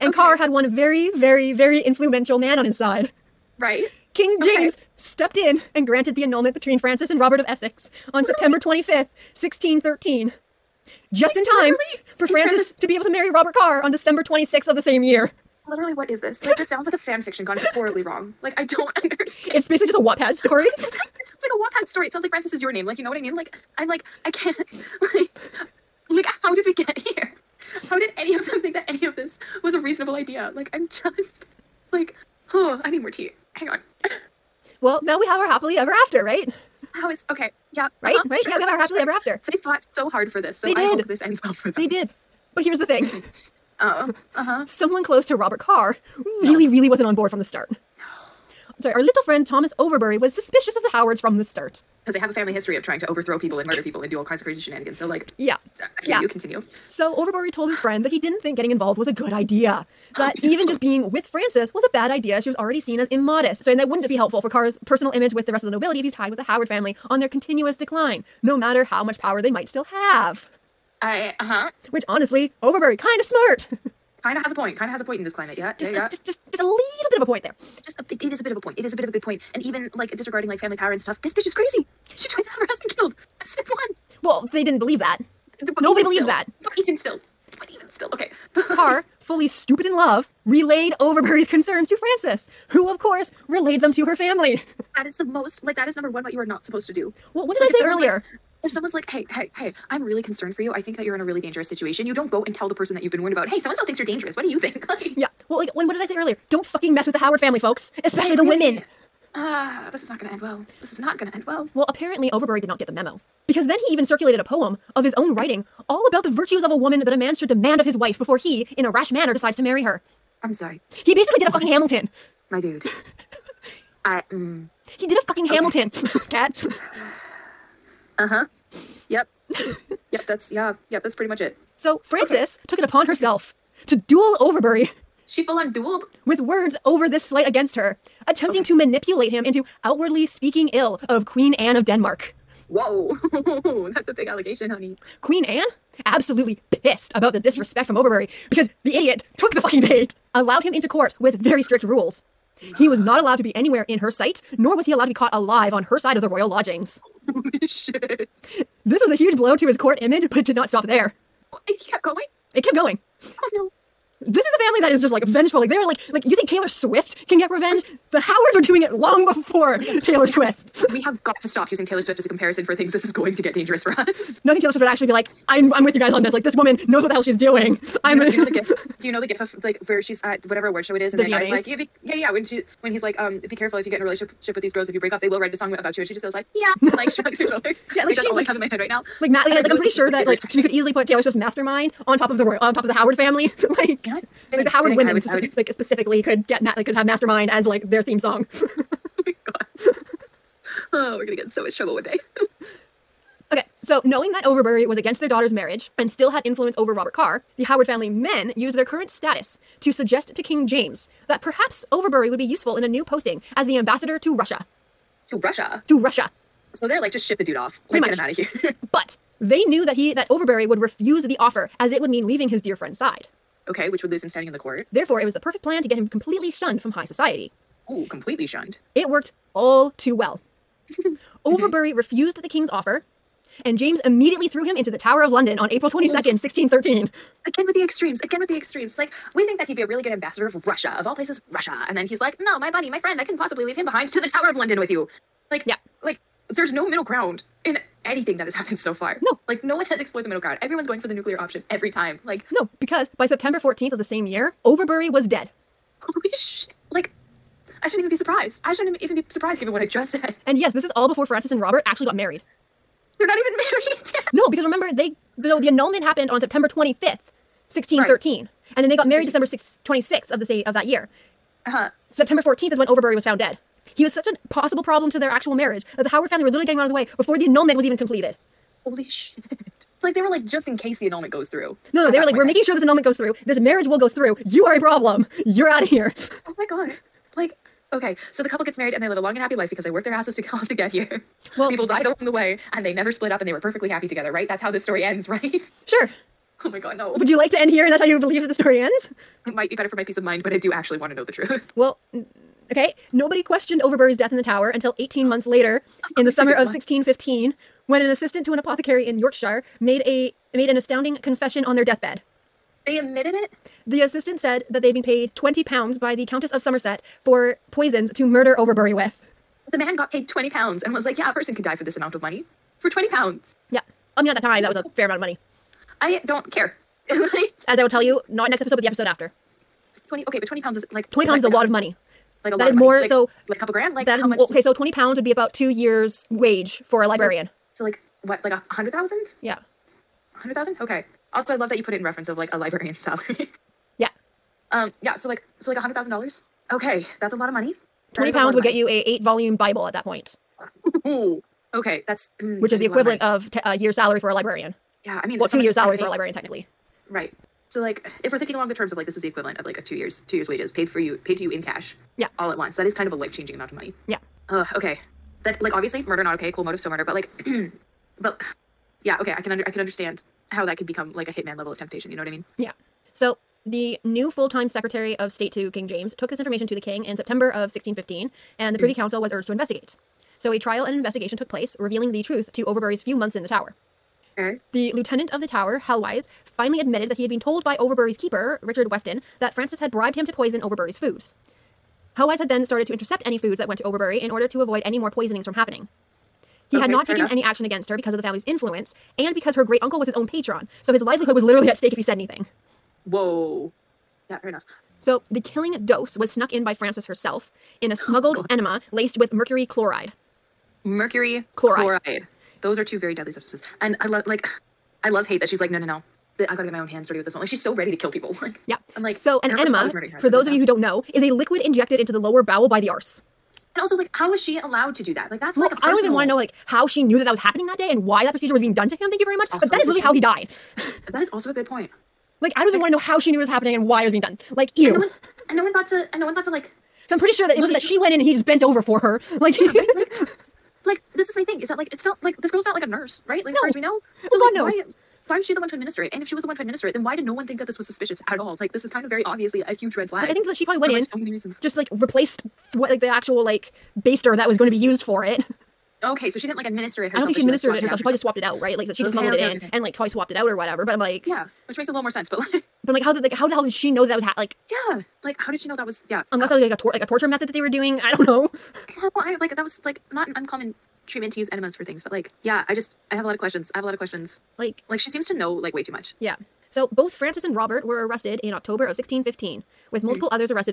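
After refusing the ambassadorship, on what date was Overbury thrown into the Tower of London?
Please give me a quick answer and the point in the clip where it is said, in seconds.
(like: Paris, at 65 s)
April 22nd, 1613, at 235 s.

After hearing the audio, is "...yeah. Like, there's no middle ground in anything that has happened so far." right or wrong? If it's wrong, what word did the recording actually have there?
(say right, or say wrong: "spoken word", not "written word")
right.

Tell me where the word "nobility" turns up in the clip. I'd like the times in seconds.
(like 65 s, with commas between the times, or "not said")
65 s.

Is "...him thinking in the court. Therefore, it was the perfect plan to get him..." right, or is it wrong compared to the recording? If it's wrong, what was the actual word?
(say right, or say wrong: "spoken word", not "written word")
wrong: "standing", not "thinking".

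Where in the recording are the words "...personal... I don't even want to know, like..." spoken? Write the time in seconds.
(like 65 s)
425 s.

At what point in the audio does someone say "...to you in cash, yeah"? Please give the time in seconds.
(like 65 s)
361 s.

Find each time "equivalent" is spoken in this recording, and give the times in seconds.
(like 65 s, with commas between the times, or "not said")
352 s, 359 s.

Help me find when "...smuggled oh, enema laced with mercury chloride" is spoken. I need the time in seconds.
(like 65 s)
407 s.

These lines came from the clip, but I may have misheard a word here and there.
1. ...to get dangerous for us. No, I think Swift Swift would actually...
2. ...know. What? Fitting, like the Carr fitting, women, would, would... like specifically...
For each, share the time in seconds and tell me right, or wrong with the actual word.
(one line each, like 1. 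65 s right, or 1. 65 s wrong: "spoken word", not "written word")
1. 173 s wrong: "Taylor", not "Swift"
2. 194 s wrong: "Howard", not "Carr".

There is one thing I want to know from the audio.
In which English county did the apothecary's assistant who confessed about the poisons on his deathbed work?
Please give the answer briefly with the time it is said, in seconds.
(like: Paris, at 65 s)
Yorkshire, at 309 s.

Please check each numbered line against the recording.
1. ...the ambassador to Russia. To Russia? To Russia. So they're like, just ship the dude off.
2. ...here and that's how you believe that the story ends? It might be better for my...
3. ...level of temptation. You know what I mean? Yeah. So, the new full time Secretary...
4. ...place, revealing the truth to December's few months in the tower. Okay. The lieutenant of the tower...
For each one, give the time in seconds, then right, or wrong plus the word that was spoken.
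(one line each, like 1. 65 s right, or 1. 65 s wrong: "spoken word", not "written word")
1. 213 s right
2. 297 s right
3. 371 s right
4. 381 s wrong: "Overbury", not "December".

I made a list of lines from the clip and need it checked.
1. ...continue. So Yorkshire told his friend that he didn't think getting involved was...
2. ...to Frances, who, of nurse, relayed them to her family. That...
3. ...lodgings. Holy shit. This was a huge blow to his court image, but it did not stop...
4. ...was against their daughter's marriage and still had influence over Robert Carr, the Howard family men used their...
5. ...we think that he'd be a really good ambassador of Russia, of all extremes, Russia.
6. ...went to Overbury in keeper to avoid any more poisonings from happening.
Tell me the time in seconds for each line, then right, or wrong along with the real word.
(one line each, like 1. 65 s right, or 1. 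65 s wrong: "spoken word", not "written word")
1. 56 s wrong: "Overbury", not "Yorkshire"
2. 91 s wrong: "course", not "nurse"
3. 156 s right
4. 204 s right
5. 239 s wrong: "places", not "extremes"
6. 393 s wrong: "order", not "keeper".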